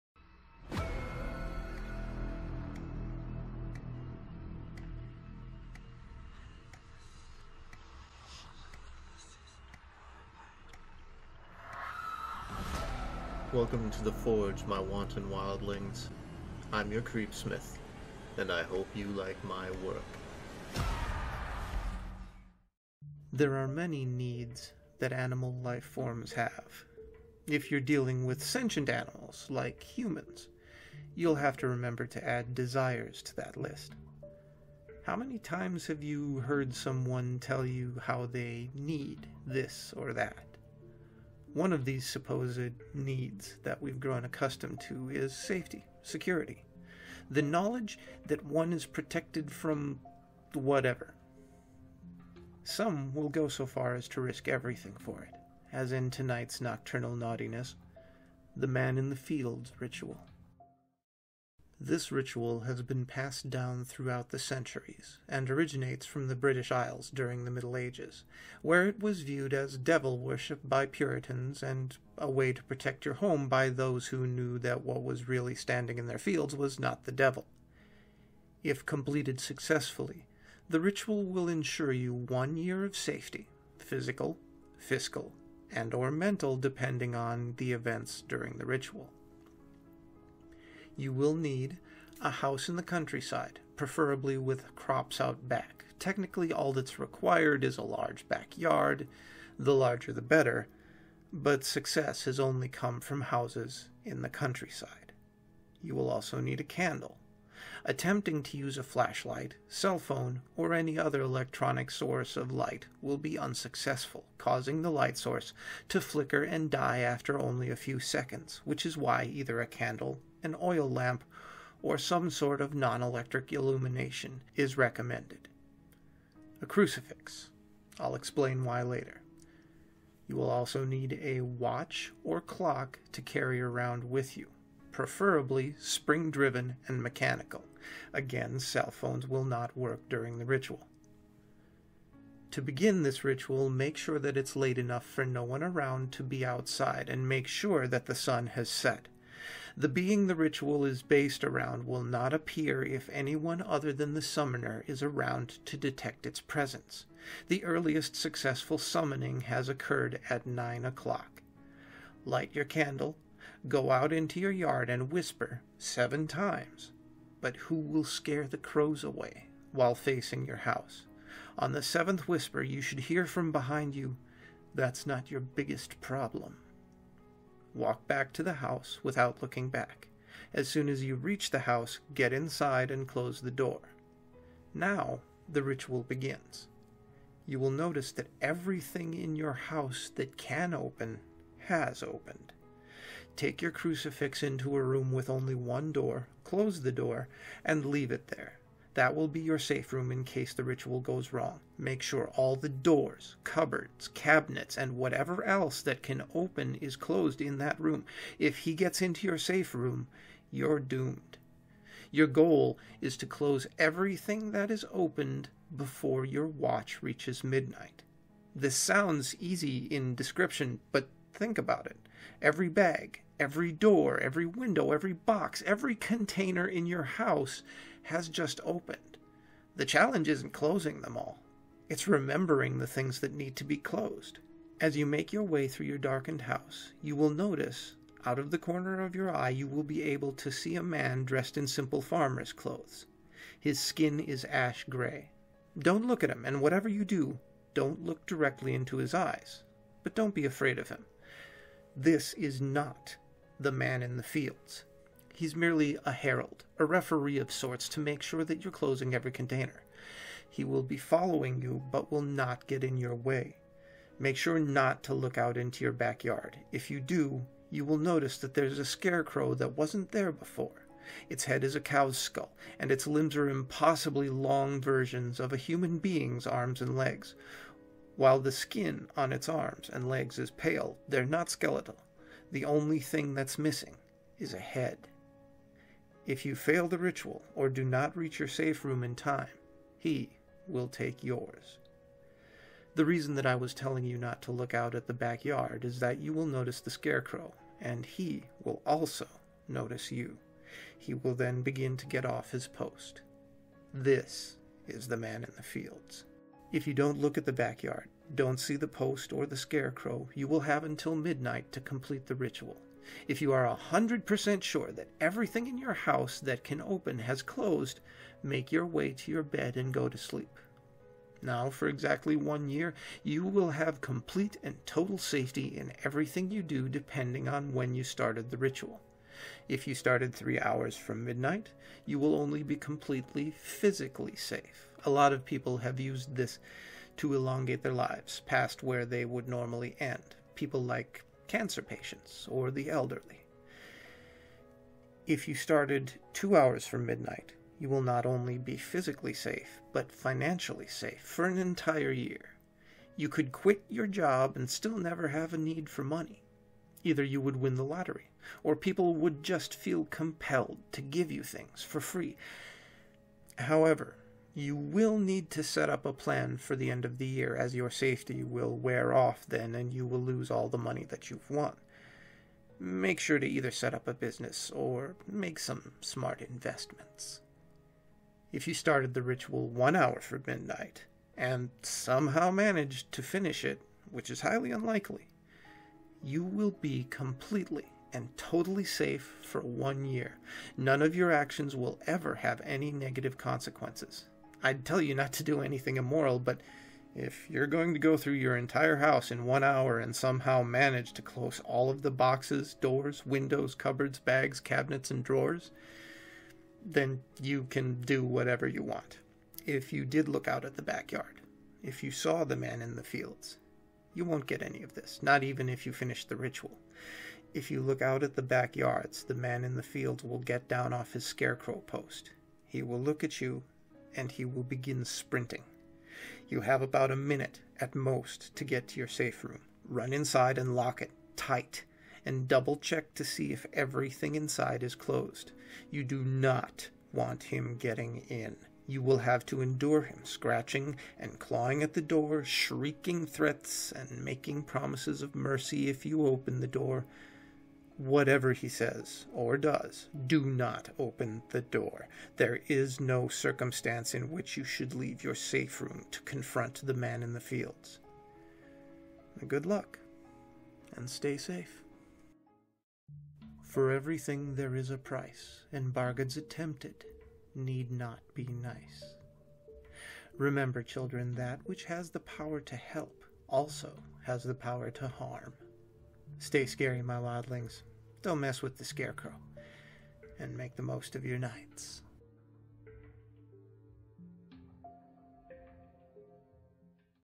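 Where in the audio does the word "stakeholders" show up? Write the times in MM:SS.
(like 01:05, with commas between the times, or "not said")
not said.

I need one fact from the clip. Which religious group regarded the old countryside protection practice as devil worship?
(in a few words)
Puritans.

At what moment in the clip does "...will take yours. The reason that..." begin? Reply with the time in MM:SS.
04:50.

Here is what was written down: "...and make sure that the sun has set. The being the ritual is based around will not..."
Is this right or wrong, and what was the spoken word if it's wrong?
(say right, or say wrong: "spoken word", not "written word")
right.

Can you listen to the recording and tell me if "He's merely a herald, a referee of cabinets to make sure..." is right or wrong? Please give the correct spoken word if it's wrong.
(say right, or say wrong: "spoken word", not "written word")
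wrong: "sorts", not "cabinets".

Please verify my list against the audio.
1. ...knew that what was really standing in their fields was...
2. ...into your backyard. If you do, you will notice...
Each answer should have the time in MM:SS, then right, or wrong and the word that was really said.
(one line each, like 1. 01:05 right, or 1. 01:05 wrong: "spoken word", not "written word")
1. 01:14 right
2. 04:25 right.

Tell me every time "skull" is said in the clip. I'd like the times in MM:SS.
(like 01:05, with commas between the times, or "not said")
04:32.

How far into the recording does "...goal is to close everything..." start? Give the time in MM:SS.
03:32.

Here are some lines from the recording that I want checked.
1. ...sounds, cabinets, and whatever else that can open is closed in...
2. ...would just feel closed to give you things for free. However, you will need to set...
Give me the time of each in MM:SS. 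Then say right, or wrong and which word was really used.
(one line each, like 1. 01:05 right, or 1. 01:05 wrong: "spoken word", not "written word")
1. 03:23 wrong: "cupboards", not "sounds"
2. 05:59 wrong: "compelled", not "closed".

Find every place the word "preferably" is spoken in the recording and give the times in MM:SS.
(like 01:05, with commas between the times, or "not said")
01:33, 02:14.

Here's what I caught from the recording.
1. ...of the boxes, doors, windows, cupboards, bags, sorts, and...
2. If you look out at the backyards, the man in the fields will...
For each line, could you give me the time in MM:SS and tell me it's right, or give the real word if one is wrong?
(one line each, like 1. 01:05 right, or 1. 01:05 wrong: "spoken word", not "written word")
1. 06:41 wrong: "cabinets", not "sorts"
2. 06:57 right.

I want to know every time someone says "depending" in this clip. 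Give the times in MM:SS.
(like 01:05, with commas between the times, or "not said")
01:26, 05:26.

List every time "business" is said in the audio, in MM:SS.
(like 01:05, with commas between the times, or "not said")
06:14.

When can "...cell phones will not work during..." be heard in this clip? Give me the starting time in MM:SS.
02:18.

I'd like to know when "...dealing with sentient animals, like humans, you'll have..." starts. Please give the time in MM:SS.
00:27.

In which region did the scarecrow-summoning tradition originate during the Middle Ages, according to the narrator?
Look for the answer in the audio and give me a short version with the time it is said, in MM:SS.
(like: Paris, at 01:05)
British Isles, at 01:06.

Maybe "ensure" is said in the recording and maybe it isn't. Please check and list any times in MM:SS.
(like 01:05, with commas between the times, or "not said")
01:21.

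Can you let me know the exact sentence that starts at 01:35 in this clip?
Technically, all that's required is a large backyard, the larger the better, but success has only come from houses in the countryside.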